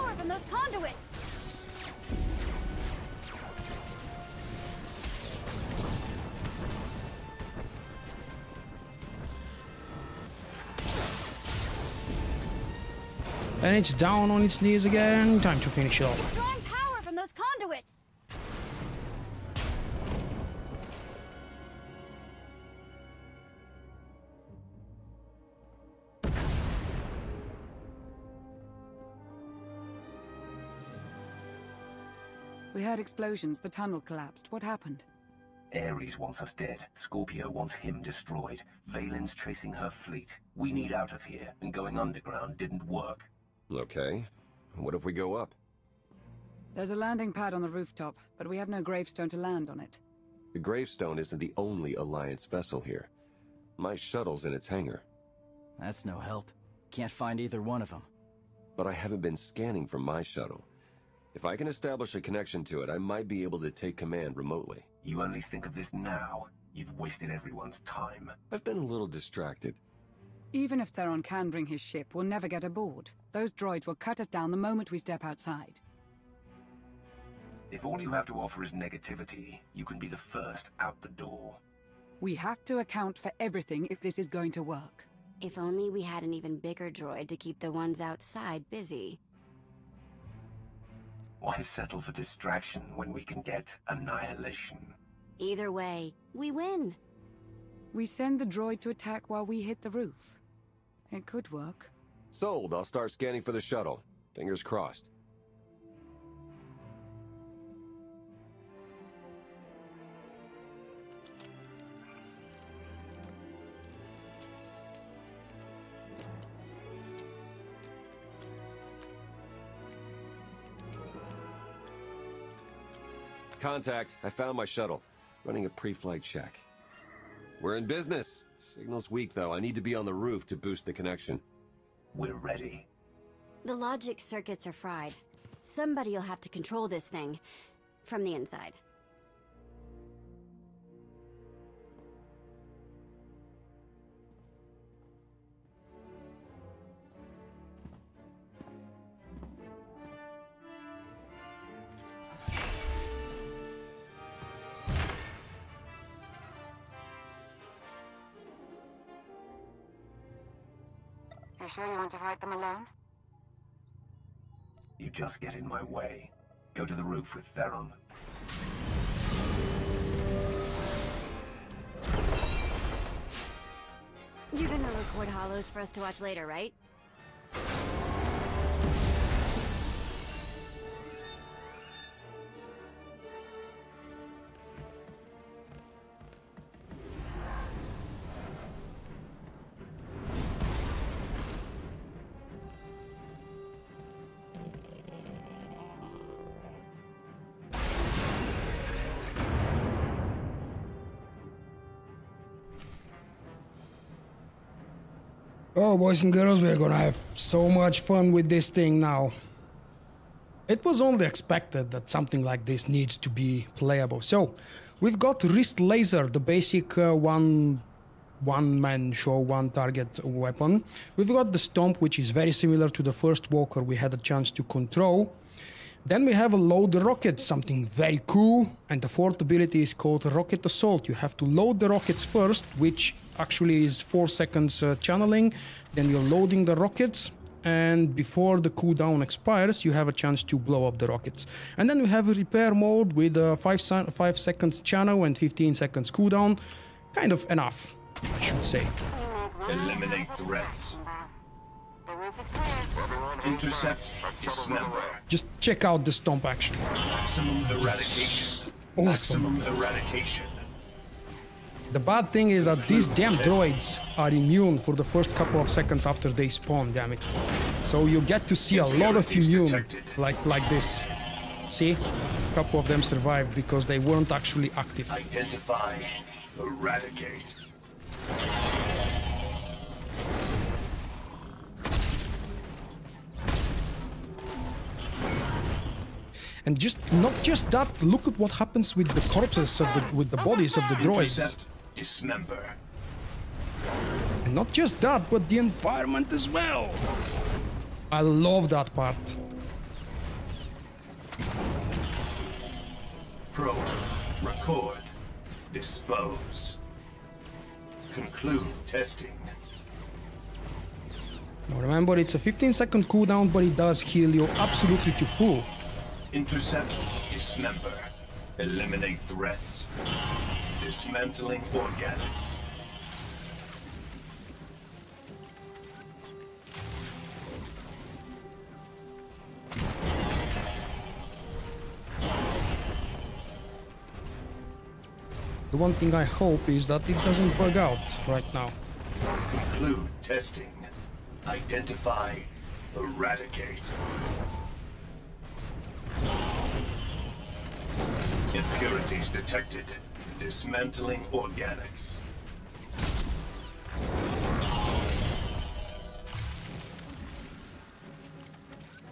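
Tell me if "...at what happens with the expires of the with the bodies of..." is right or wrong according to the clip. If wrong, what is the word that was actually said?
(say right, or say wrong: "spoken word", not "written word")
wrong: "corpses", not "expires".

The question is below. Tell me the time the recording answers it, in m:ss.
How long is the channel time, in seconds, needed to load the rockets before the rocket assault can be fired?
3:54.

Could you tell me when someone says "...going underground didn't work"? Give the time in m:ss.
0:41.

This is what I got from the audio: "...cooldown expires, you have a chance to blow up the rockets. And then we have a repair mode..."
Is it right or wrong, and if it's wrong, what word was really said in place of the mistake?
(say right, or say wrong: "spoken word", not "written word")
right.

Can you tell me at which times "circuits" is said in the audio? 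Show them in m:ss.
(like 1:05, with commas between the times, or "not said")
2:14.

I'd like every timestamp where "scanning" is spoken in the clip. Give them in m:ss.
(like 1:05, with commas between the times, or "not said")
0:59, 1:43.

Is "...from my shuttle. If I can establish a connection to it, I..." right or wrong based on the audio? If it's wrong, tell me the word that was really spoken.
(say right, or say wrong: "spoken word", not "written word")
right.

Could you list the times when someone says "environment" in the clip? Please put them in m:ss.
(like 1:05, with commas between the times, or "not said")
4:55.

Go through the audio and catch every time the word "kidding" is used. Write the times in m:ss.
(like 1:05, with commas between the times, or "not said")
not said.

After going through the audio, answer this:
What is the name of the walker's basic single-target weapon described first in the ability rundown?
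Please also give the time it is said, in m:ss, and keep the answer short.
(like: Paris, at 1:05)
Wrist Laser, at 3:35.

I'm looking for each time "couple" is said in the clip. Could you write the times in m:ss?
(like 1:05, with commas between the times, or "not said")
4:25, 4:32.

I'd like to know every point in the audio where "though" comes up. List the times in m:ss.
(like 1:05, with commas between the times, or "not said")
2:09.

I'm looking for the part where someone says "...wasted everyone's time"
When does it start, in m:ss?
1:06.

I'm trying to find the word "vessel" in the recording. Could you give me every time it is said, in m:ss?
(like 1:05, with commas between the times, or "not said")
0:52.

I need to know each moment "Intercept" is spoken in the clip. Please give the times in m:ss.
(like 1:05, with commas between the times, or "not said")
4:13, 4:51, 5:16.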